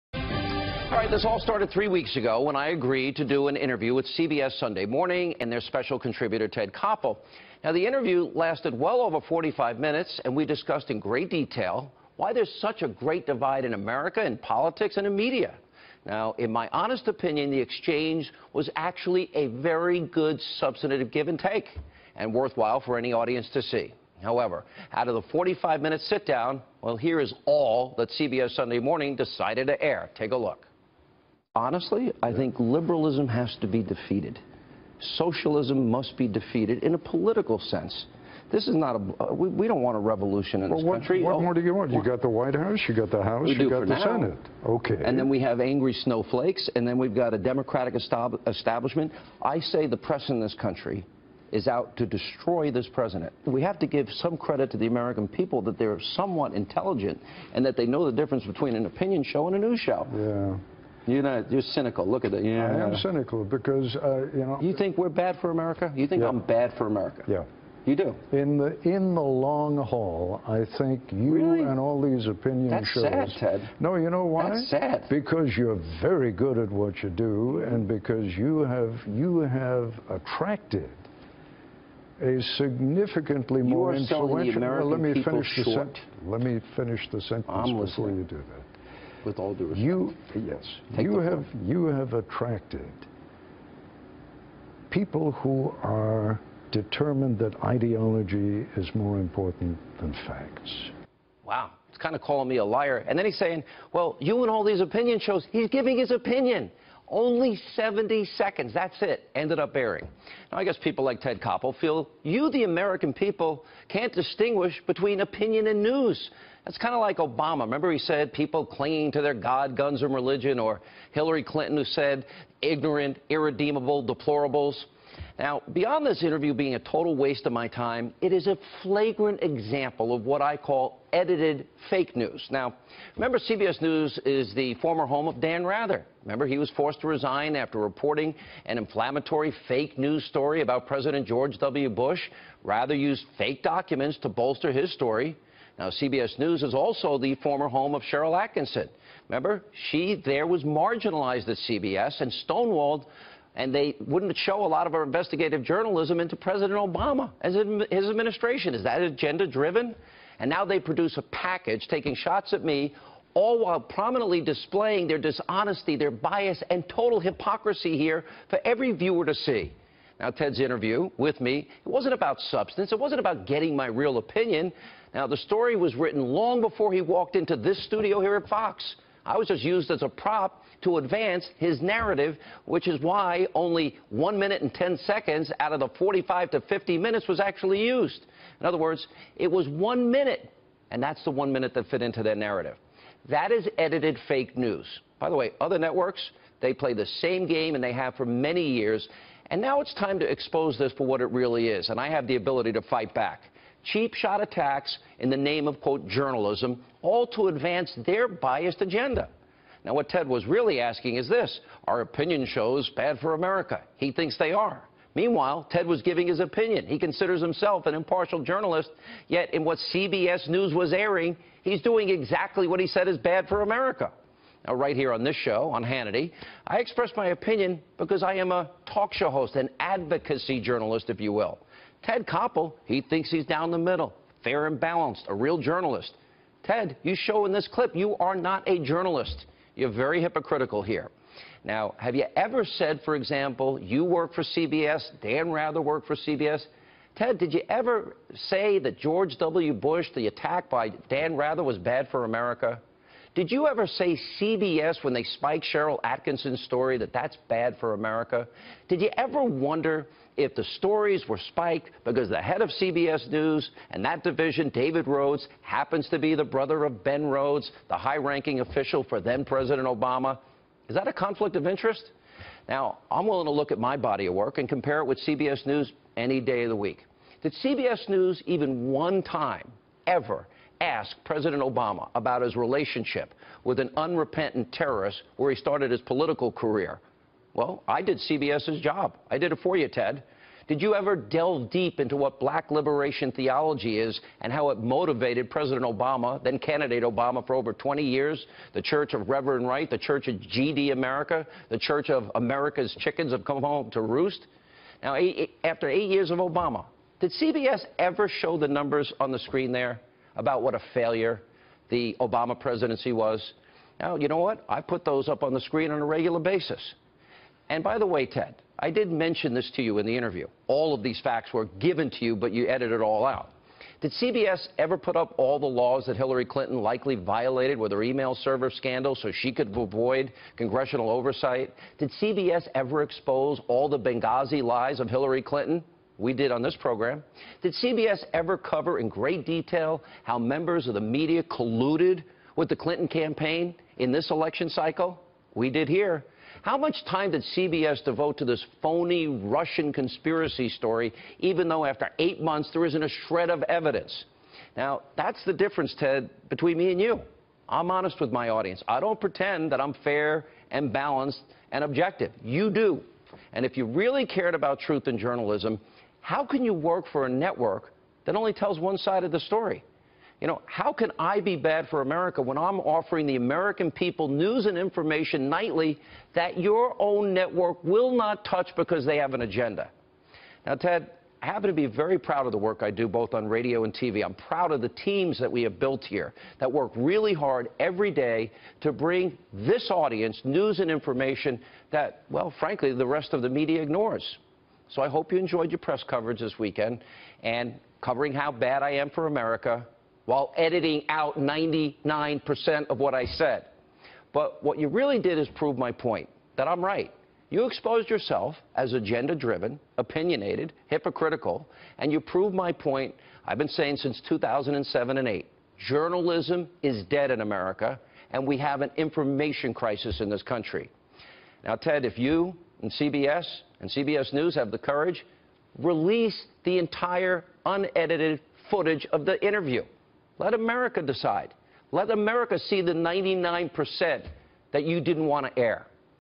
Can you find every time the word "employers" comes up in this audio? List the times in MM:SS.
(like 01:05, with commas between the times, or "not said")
not said.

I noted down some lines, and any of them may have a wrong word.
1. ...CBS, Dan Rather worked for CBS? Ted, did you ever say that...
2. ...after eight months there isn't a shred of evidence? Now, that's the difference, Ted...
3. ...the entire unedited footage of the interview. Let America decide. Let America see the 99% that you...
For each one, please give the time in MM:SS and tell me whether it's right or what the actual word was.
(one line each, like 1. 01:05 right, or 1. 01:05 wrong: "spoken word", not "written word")
1. 04:04 right
2. 05:51 right
3. 07:06 right.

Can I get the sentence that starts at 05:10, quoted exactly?
about what a failure the Obama presidency was.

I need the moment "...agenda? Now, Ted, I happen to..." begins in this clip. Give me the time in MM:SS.
06:19.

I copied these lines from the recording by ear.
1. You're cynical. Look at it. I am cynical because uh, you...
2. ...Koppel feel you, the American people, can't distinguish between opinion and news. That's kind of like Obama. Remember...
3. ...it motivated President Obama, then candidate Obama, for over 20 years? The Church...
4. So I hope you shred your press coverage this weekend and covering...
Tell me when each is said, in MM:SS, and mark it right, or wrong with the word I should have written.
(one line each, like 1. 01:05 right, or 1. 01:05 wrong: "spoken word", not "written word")
1. 01:01 right
2. 01:51 right
3. 04:54 right
4. 06:34 wrong: "enjoyed", not "shred".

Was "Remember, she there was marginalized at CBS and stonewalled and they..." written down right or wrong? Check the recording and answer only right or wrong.
right.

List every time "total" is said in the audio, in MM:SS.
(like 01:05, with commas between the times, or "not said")
02:06, 02:46.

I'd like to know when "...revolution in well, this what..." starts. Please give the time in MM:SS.
00:39.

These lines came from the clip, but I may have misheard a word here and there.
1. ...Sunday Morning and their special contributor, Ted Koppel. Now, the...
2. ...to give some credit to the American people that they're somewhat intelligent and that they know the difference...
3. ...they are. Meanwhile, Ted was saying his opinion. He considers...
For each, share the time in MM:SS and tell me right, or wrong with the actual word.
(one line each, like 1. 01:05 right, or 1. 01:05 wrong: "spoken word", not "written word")
1. 00:04 right
2. 00:53 right
3. 03:34 wrong: "giving", not "saying".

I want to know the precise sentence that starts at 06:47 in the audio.
You exposed yourself as agenda driven, opinionated, hypocritical, and you proved my point I've been saying since 2007 and 8.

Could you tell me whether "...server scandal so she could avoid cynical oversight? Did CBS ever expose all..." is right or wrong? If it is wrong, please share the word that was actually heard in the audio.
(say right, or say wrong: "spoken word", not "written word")
wrong: "congressional", not "cynical".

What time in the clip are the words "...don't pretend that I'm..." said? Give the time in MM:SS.
05:58.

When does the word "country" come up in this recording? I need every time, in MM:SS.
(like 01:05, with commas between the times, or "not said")
00:40, 00:50, 07:00.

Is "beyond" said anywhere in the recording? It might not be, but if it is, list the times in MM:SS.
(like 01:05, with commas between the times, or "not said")
02:05.